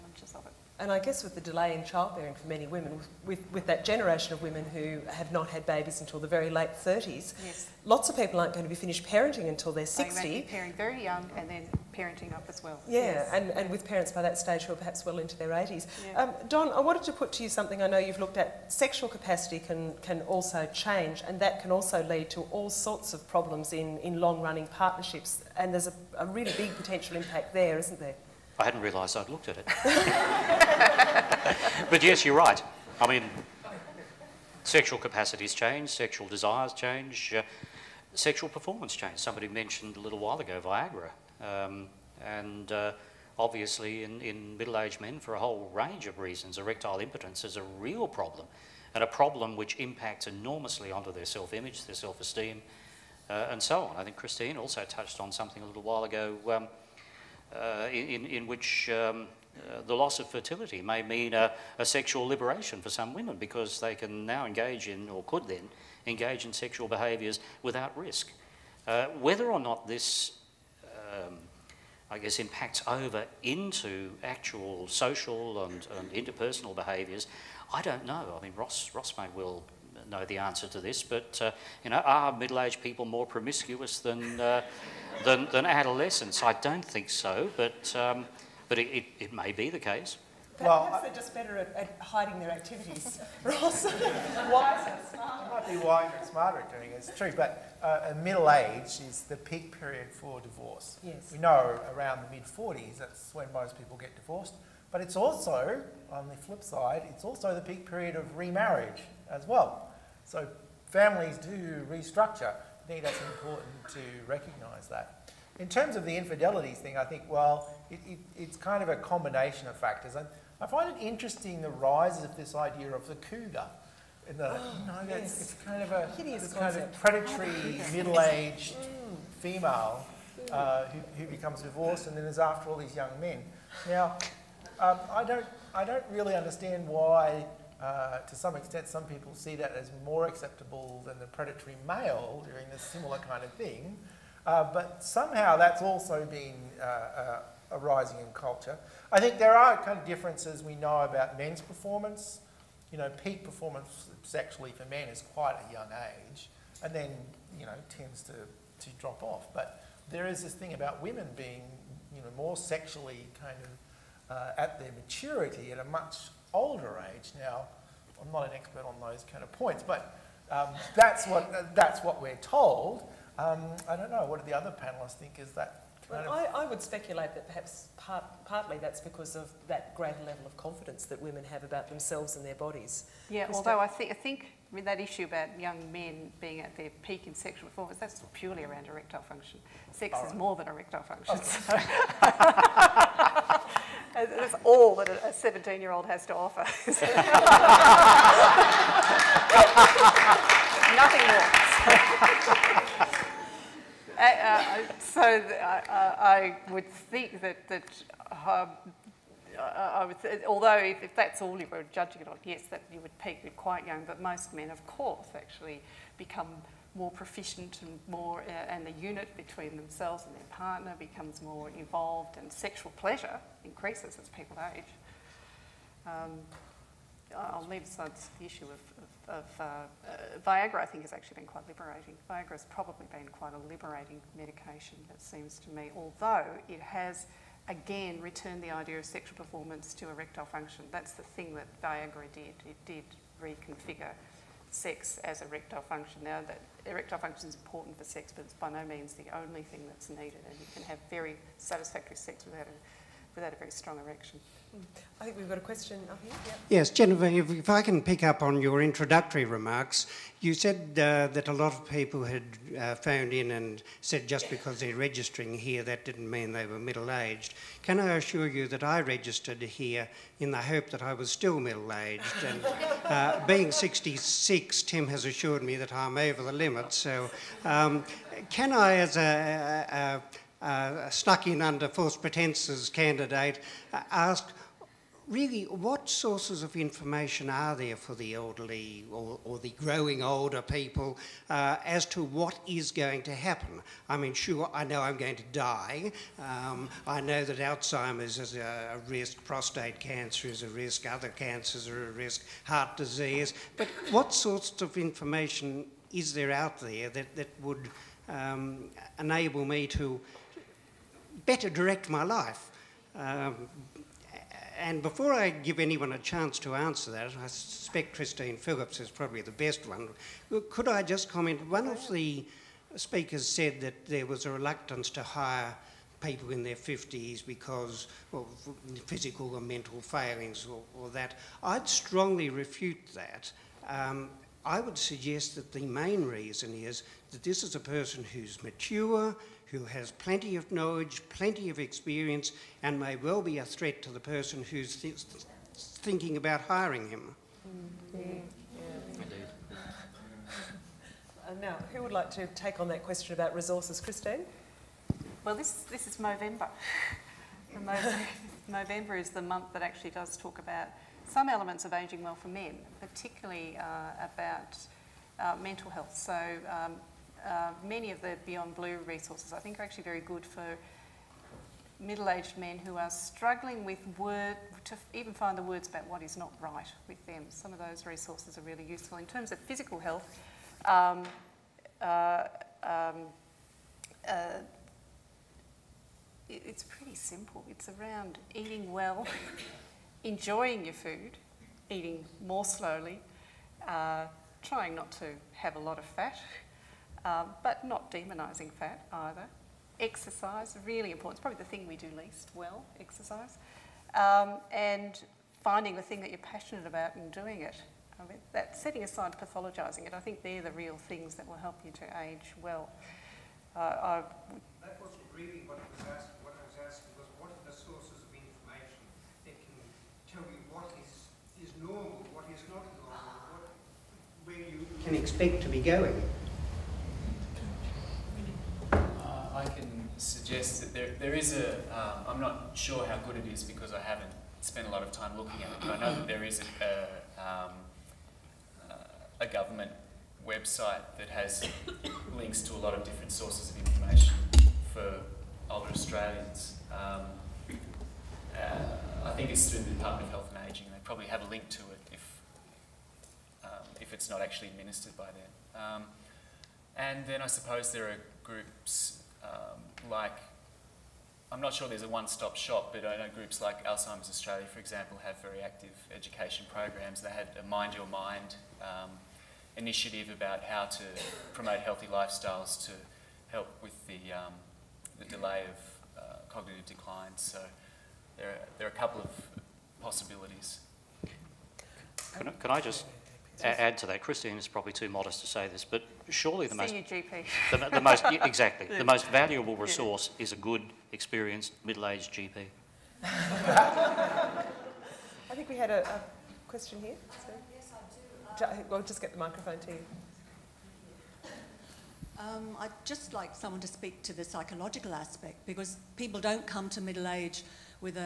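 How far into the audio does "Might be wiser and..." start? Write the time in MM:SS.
01:35.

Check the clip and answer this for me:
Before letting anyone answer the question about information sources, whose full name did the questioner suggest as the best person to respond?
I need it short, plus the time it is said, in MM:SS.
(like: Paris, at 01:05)
Christine Phillips, at 05:18.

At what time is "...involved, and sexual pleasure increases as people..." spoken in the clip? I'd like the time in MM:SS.
03:41.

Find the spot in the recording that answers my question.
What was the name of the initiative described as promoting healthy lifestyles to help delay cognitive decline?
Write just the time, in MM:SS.
07:47.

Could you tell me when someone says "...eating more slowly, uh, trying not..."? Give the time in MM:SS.
06:31.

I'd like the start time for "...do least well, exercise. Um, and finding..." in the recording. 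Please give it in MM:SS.
06:41.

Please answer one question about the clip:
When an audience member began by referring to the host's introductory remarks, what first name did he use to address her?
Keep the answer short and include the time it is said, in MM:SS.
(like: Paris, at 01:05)
Genevieve, at 04:16.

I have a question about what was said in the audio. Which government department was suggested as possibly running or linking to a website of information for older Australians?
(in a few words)
Department of Health and Aging.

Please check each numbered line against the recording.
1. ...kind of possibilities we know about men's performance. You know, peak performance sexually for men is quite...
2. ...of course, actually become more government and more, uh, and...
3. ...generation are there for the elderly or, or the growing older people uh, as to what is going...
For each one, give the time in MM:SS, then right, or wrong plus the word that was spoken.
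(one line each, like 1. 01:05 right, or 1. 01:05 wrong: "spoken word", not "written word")
1. 02:29 wrong: "differences", not "possibilities"
2. 03:34 wrong: "proficient", not "government"
3. 04:46 wrong: "information", not "generation".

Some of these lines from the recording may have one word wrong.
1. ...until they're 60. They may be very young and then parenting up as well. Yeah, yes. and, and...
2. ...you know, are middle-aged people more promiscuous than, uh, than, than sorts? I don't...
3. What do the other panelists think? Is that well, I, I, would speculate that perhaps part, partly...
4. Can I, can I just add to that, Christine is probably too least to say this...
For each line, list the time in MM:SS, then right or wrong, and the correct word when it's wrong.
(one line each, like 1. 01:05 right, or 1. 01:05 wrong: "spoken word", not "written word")
1. 00:09 right
2. 01:21 wrong: "adolescents", not "sorts"
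3. 02:54 right
4. 08:02 wrong: "modest", not "least".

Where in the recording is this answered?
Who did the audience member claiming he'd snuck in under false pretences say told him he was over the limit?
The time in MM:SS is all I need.
04:34.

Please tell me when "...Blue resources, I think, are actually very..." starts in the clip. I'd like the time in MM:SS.
06:08.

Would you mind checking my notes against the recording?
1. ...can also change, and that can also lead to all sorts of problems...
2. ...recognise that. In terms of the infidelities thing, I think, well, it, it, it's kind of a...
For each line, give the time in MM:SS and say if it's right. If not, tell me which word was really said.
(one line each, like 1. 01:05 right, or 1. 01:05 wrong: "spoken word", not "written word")
1. 00:20 right
2. 01:54 right.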